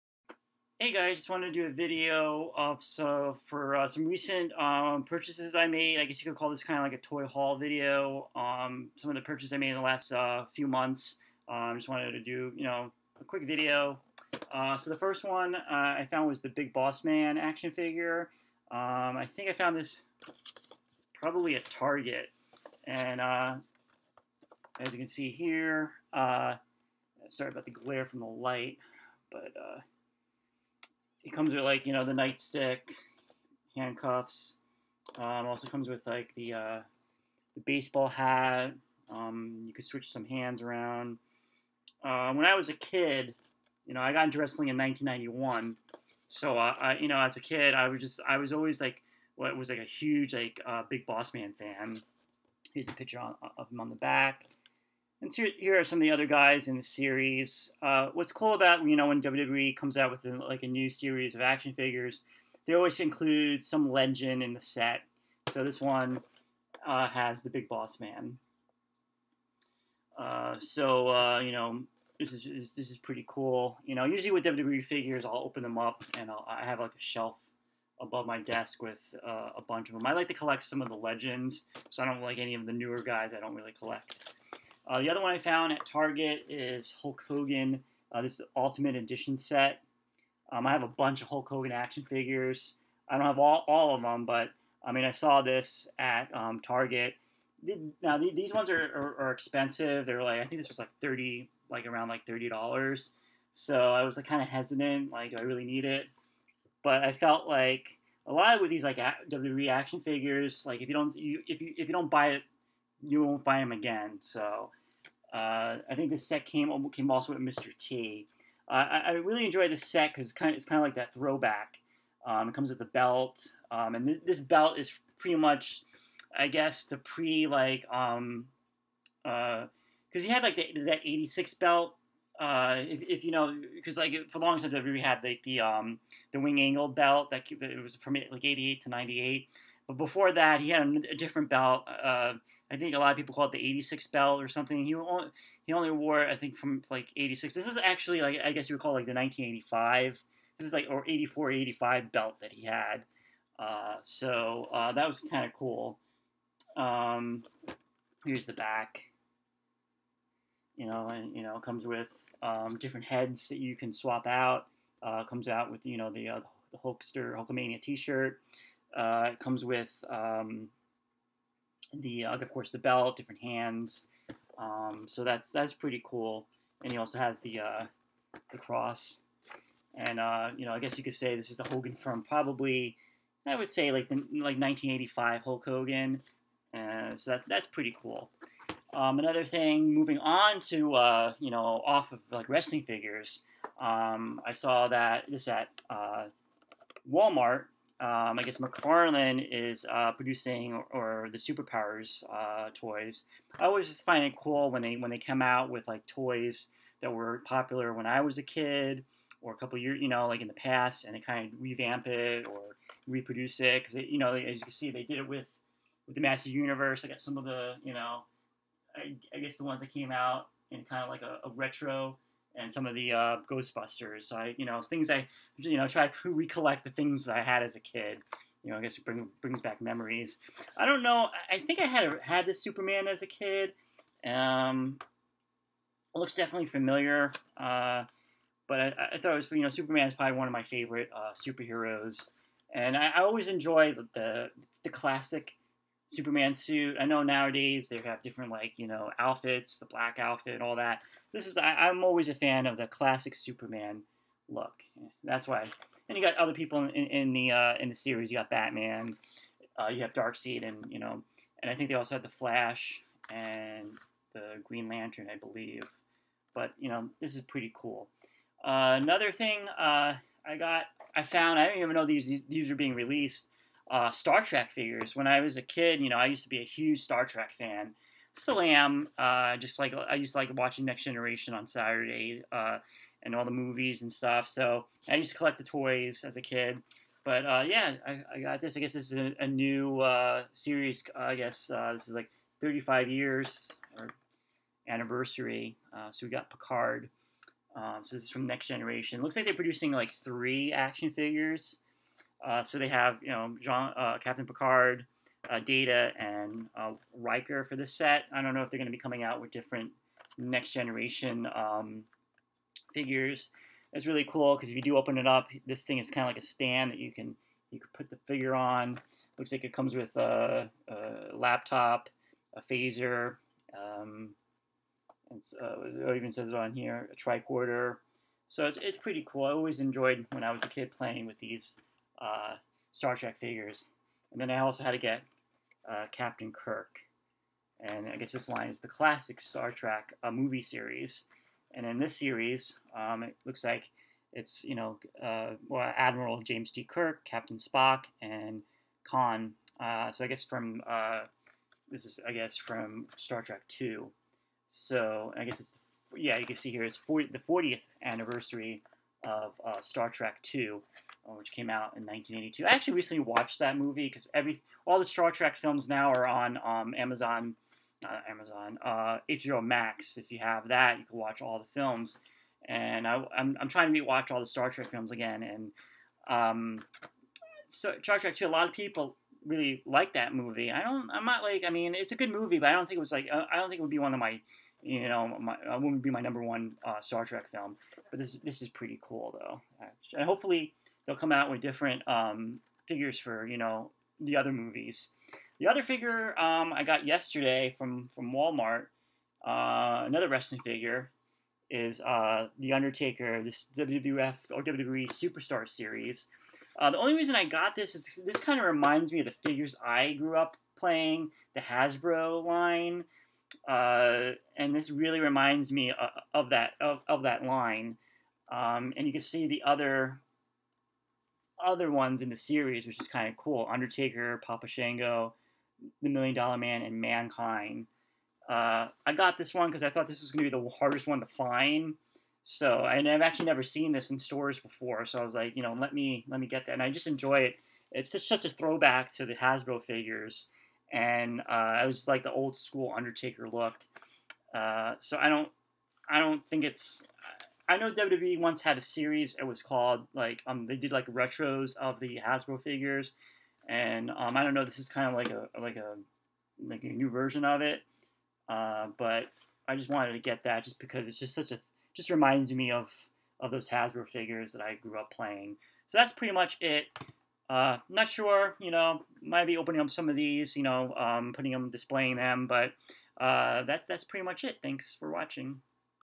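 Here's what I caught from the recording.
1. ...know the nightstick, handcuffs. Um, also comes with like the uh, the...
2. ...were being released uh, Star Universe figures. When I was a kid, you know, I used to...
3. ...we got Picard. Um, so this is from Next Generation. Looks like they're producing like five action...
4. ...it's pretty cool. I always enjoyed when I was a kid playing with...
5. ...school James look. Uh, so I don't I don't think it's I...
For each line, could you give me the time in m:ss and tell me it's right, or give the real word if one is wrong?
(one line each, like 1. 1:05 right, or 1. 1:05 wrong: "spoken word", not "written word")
1. 0:31 right
2. 4:32 wrong: "Trek", not "Universe"
3. 4:56 wrong: "three", not "five"
4. 5:28 right
5. 7:22 wrong: "Undertaker", not "James".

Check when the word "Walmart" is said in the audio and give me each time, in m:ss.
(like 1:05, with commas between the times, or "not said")
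3:17, 6:38.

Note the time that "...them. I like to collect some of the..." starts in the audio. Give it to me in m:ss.
1:19.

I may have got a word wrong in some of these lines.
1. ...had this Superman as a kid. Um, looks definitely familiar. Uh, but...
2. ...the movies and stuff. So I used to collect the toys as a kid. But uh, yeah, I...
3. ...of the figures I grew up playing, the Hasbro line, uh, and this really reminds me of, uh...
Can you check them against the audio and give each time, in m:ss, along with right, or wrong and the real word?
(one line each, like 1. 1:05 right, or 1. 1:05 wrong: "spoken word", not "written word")
1. 3:52 right
2. 4:43 right
3. 6:49 right.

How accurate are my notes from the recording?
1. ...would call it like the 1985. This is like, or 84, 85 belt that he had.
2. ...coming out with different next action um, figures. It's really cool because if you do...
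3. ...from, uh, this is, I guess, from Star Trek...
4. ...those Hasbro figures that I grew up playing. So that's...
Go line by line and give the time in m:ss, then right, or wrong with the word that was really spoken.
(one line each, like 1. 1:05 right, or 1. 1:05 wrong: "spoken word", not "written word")
1. 2:28 right
2. 5:08 wrong: "generation", not "action"
3. 5:50 right
4. 7:43 right.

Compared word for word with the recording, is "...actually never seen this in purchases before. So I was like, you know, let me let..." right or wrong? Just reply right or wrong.
wrong.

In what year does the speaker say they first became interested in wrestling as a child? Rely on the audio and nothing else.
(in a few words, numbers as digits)
1991.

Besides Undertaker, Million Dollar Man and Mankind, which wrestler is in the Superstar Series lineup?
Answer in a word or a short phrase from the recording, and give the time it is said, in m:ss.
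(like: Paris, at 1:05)
Papa Shango, at 7:04.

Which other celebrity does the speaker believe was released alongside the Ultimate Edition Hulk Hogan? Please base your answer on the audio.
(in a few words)
Mr. T.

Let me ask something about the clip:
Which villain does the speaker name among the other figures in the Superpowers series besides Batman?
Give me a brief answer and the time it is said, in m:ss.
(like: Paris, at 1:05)
Darkseid, at 4:20.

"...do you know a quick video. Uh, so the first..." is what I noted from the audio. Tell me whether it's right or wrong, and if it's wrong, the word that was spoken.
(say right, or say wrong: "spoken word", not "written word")
right.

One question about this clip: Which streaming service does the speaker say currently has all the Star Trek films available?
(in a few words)
HBO Max.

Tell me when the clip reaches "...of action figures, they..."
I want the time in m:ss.
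1:01.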